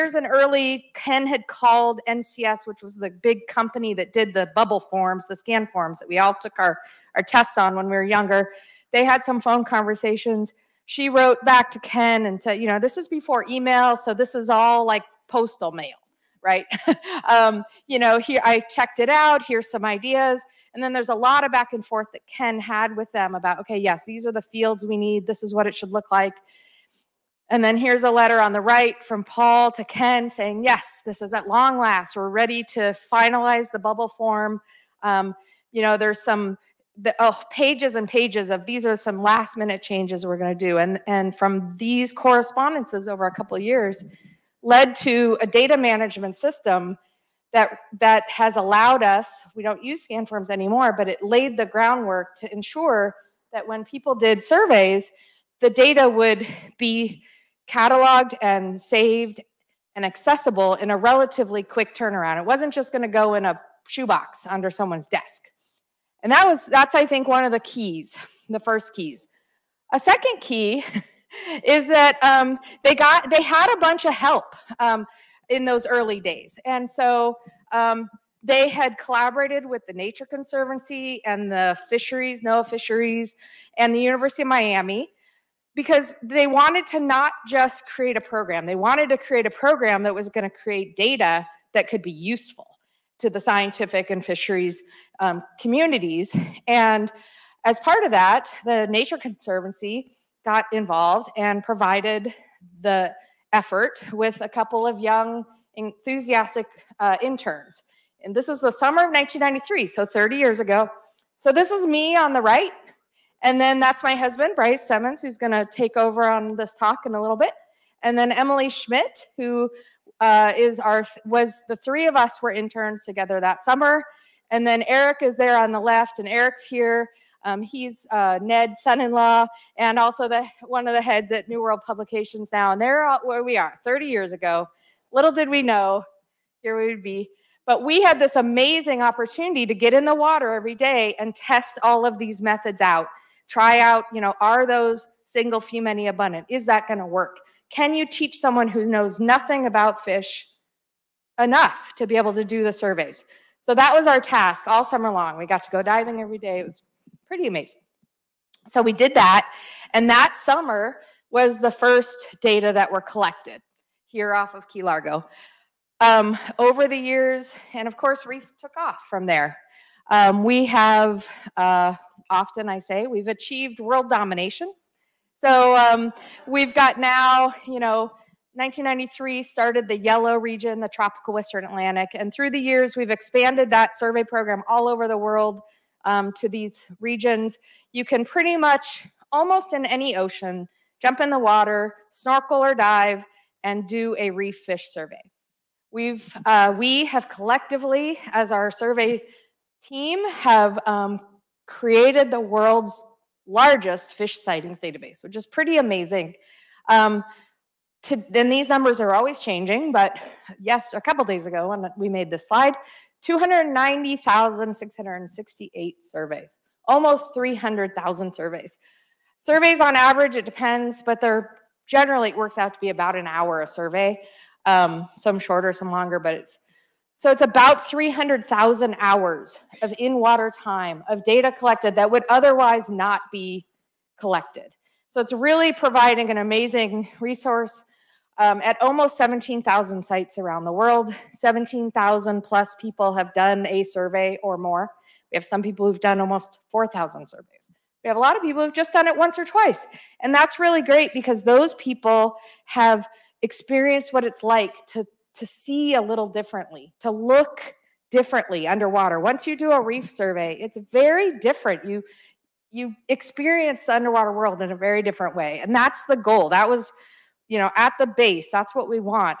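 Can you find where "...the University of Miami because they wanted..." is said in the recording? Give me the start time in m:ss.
1:23.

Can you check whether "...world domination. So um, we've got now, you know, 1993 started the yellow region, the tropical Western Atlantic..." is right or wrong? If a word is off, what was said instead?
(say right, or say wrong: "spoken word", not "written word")
right.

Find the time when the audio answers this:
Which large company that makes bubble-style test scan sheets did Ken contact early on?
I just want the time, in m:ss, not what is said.
0:02.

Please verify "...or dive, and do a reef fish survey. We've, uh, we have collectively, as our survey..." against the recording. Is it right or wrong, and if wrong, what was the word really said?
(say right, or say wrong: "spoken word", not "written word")
right.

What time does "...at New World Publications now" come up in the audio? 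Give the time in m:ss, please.
2:11.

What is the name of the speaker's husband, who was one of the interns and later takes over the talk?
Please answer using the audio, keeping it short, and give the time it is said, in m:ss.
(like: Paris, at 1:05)
Brice Semmens, at 1:54.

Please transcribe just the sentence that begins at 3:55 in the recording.
So it's really providing an amazing resource um, at almost 17,000 sites around the world.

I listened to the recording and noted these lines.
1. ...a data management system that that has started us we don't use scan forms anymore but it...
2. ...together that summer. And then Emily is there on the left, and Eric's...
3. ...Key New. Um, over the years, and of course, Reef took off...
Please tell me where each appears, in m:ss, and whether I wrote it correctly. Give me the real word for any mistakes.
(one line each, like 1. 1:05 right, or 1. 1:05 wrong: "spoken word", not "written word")
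1. 0:45 wrong: "allowed", not "started"
2. 2:03 wrong: "Eric", not "Emily"
3. 2:44 wrong: "Largo", not "New".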